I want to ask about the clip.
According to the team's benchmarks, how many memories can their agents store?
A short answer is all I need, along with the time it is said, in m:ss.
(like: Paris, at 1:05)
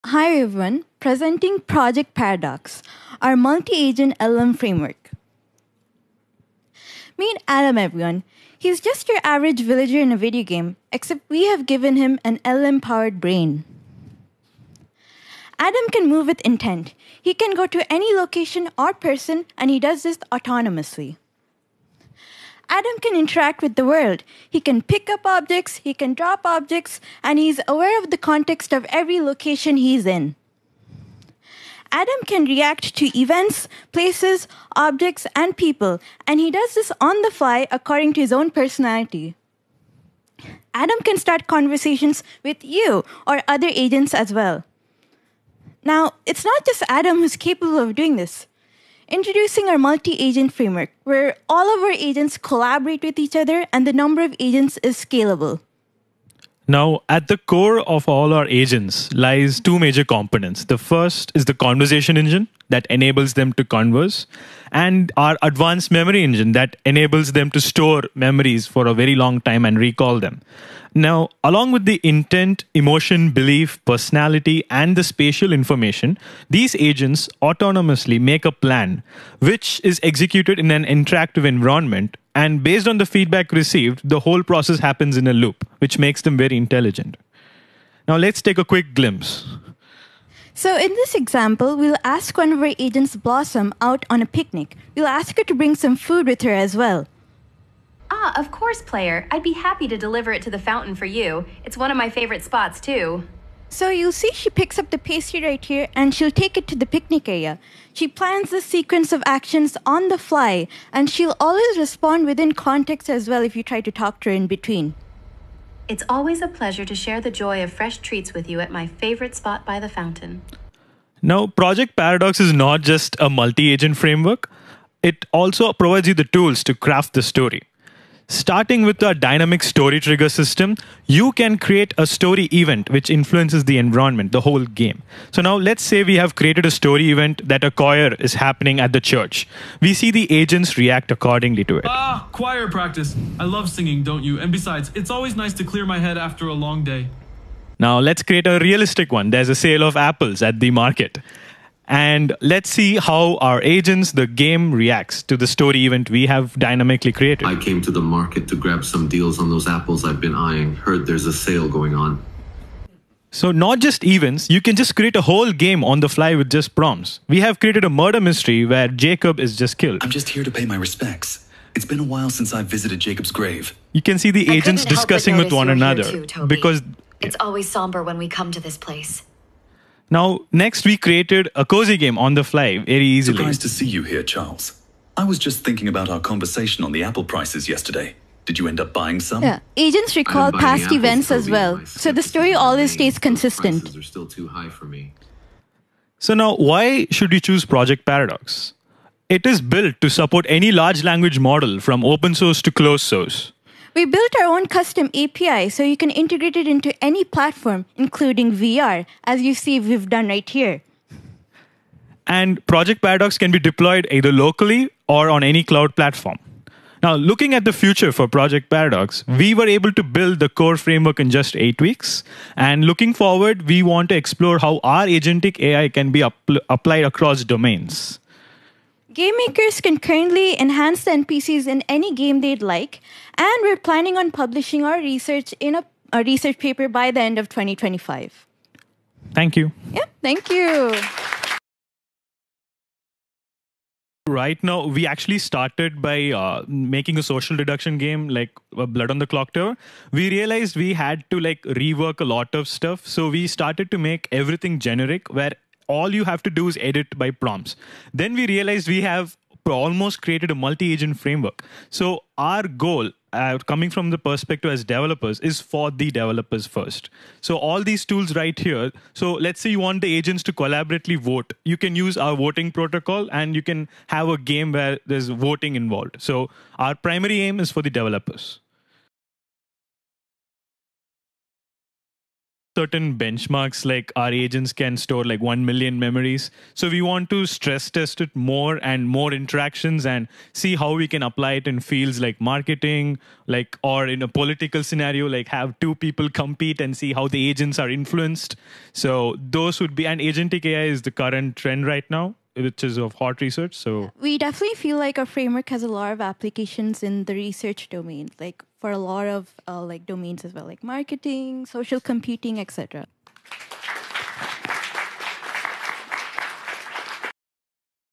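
1 million, at 4:45.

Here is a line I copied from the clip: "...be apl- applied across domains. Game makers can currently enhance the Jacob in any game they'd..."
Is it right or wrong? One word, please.
wrong.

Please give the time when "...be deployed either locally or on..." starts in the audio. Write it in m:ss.
3:33.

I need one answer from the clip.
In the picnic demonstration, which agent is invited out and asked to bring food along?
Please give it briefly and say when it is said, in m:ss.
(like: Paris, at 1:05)
Blossom, at 1:33.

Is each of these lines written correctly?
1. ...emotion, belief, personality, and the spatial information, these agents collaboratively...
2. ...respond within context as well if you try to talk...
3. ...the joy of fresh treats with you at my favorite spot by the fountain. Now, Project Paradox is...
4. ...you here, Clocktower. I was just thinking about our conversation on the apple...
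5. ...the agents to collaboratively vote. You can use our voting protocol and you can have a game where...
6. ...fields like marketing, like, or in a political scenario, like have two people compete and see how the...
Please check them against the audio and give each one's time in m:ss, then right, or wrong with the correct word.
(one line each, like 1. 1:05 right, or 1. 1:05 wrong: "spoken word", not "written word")
1. 1:12 wrong: "autonomously", not "collaboratively"
2. 1:51 right
3. 1:57 right
4. 3:03 wrong: "Charles", not "Clocktower"
5. 4:30 right
6. 4:51 right.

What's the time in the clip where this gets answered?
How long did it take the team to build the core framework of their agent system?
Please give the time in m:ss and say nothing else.
3:41.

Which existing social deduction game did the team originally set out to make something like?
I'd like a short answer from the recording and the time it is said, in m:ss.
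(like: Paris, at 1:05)
Blood on the Clocktower, at 4:08.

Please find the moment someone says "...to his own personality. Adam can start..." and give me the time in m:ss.
0:38.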